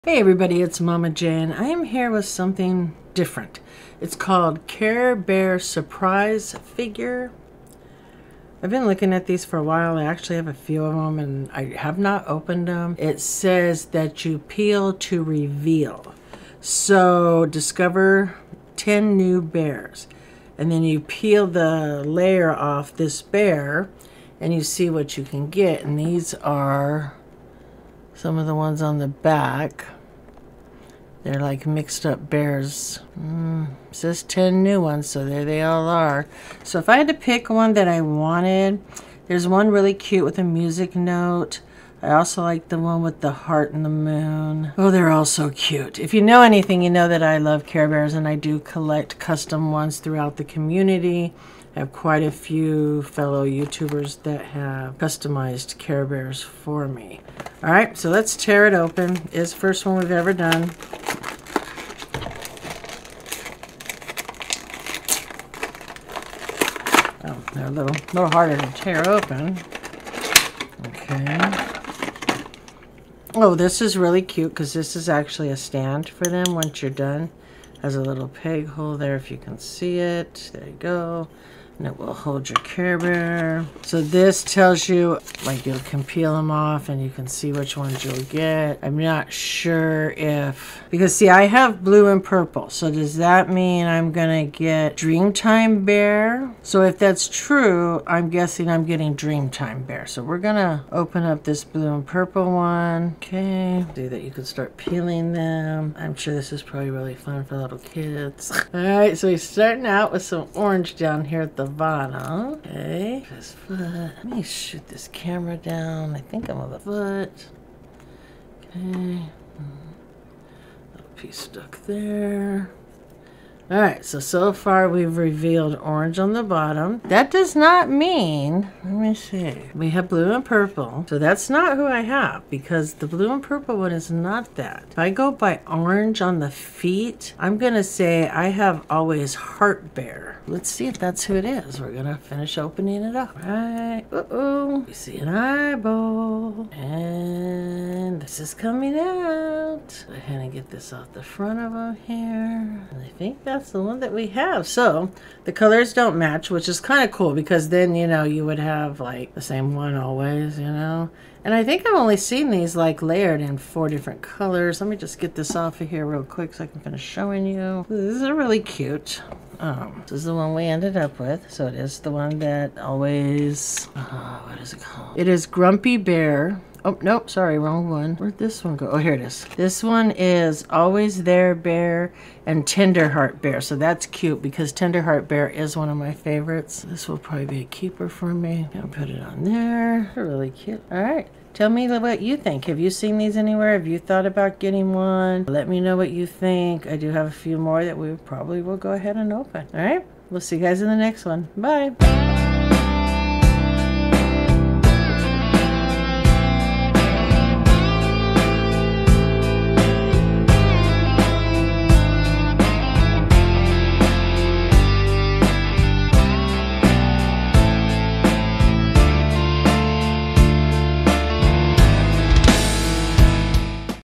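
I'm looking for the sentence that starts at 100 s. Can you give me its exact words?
So we're gonna open up this blue and purple one.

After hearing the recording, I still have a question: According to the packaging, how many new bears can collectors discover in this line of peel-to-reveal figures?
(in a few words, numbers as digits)
10.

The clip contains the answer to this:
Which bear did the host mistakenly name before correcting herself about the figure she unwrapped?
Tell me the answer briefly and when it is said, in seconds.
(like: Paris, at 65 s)
Grumpy Bear, at 175 s.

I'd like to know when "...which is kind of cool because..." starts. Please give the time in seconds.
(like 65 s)
156 s.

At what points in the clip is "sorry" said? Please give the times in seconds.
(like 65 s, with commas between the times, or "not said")
177 s.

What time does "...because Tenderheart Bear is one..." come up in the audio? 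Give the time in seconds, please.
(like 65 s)
184 s.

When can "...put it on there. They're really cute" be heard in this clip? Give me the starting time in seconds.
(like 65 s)
188 s.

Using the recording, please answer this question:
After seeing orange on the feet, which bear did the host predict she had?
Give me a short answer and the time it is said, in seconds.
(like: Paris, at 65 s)
Always Heart Bear, at 138 s.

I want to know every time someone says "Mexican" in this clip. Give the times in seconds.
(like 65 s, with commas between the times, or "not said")
not said.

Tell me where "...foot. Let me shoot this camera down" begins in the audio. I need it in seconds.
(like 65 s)
113 s.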